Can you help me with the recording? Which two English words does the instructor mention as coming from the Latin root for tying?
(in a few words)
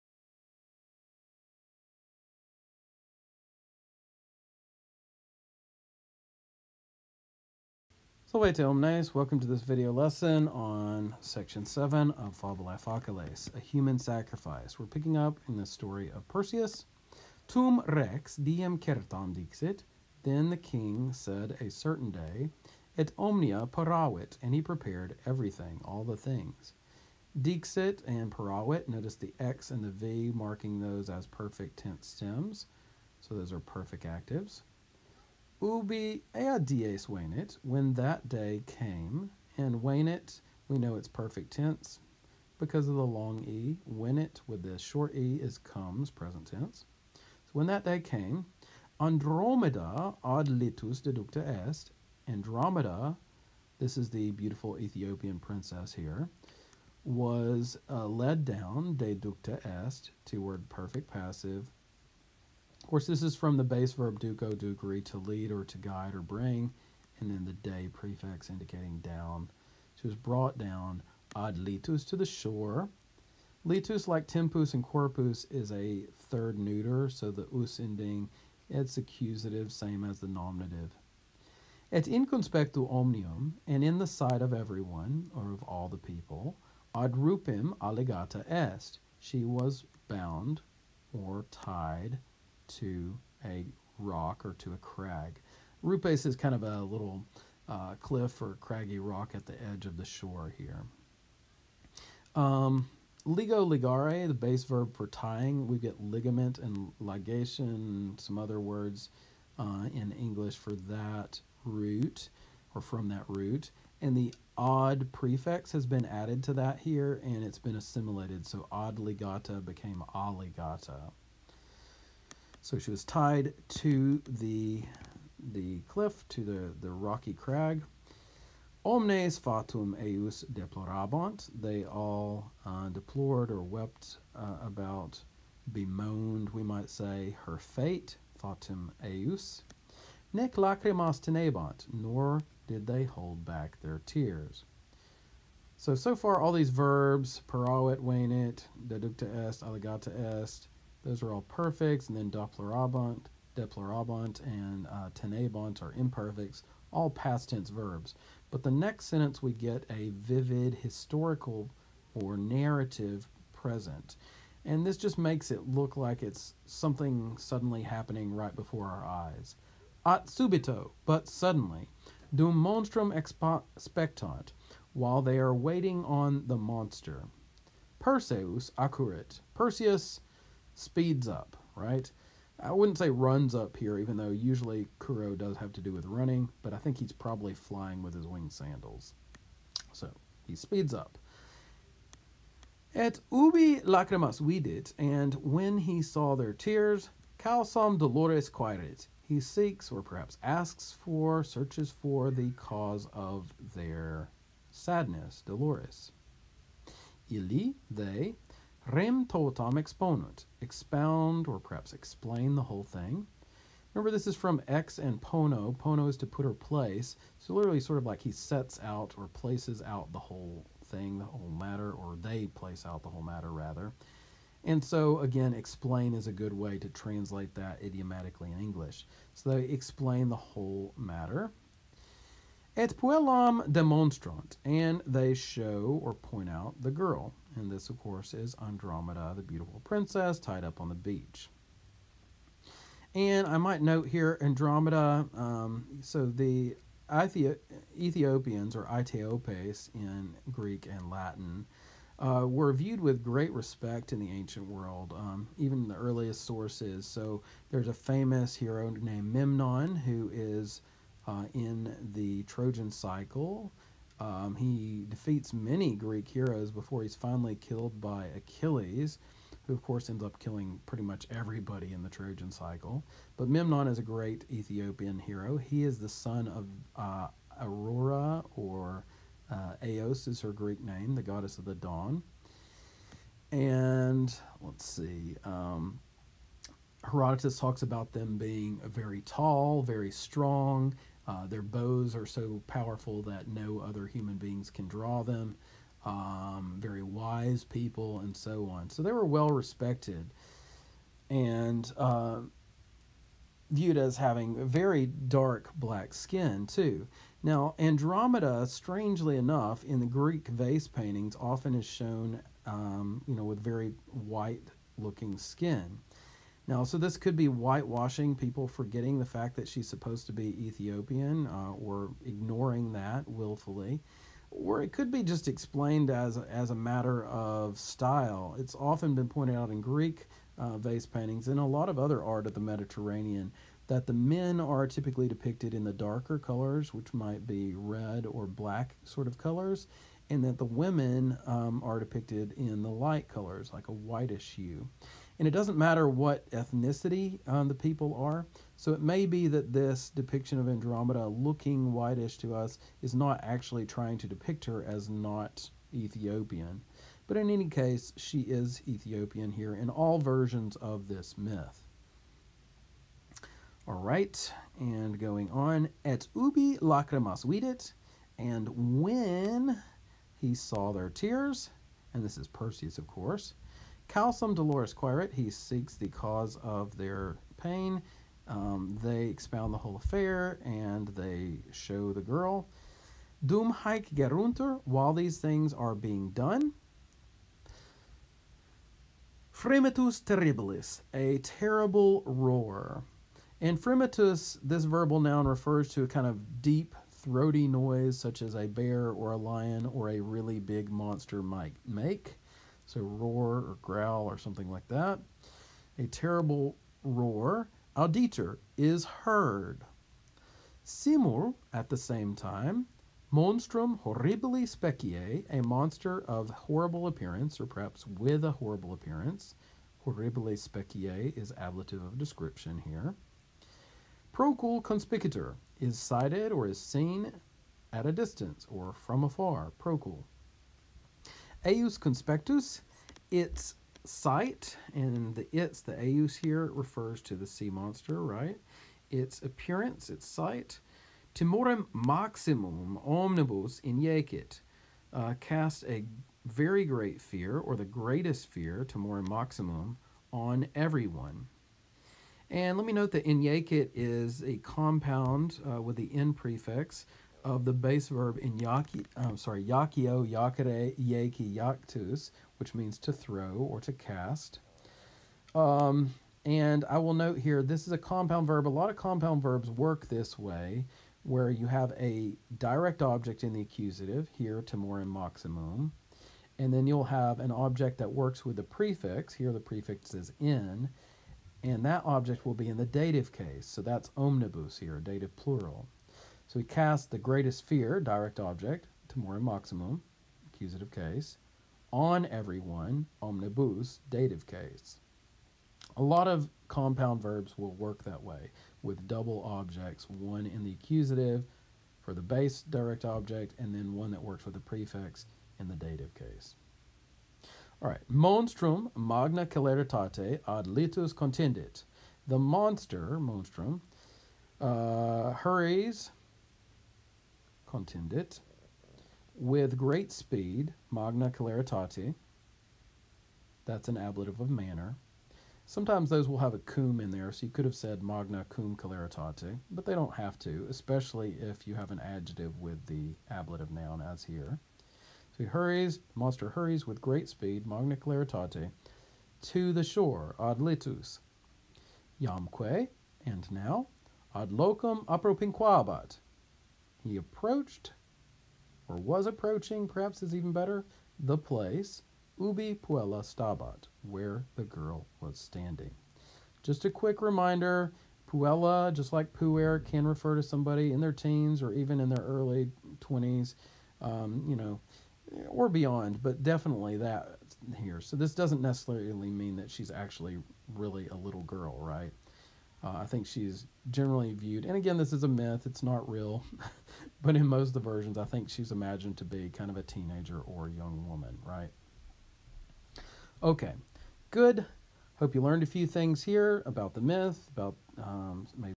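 ligament and ligation.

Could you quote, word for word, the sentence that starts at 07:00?
Horribile specie is ablative of description here.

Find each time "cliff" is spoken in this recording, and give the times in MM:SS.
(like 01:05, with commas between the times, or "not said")
01:37, 02:05.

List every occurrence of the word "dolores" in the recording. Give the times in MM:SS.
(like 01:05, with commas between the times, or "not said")
03:17, 03:25, 06:14.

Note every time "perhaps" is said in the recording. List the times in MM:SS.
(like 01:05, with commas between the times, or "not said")
03:20, 03:31, 06:57, 09:09.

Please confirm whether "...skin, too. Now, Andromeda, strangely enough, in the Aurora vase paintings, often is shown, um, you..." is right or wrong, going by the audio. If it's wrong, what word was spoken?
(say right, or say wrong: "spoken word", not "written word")
wrong: "Greek", not "Aurora".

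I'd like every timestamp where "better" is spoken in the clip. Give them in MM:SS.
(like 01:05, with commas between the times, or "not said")
09:10.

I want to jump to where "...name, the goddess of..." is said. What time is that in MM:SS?
04:40.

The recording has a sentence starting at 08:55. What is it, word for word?
So he hurries, monster hurries with great speed, magna celeritate, to the shore, ad litus.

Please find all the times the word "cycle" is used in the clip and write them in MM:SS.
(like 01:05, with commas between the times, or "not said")
04:22, 04:32.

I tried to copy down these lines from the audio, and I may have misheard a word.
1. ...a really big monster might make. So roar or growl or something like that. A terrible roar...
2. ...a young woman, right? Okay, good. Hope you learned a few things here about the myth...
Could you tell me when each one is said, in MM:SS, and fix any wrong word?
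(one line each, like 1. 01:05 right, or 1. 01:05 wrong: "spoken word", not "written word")
1. 06:40 right
2. 09:40 right.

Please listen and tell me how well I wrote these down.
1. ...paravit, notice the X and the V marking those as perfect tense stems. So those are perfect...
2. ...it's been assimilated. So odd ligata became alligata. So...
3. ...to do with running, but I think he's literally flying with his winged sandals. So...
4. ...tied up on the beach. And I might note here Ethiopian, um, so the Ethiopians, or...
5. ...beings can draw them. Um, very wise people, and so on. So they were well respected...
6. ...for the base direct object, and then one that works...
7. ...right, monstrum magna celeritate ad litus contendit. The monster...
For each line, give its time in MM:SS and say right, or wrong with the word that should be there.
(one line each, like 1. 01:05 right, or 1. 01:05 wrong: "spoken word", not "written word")
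1. 00:28 right
2. 01:57 right
3. 03:05 wrong: "probably", not "literally"
4. 04:00 wrong: "Andromeda", not "Ethiopian"
5. 04:54 right
6. 08:22 right
7. 08:27 right.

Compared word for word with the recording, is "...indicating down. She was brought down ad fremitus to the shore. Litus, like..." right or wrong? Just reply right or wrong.
wrong.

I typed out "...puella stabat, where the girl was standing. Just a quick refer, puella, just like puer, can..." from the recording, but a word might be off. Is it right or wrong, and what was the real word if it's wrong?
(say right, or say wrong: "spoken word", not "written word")
wrong: "reminder", not "refer".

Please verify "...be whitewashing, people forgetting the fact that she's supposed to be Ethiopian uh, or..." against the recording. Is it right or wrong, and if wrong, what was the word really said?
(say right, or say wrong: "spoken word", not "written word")
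right.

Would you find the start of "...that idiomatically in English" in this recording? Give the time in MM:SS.
03:47.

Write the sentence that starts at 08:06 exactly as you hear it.
So we cast the greatest fear, direct object, timorem maximum, accusative case, on everyone, omnibus, dative case.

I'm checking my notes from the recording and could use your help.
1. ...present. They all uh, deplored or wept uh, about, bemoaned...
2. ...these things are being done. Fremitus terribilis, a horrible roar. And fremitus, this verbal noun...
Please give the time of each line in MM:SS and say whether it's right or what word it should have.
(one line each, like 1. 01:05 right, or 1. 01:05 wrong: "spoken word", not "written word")
1. 02:10 wrong: "deplorabant", not "present"
2. 06:25 wrong: "terrible", not "horrible".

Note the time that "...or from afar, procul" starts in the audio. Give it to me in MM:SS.
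07:08.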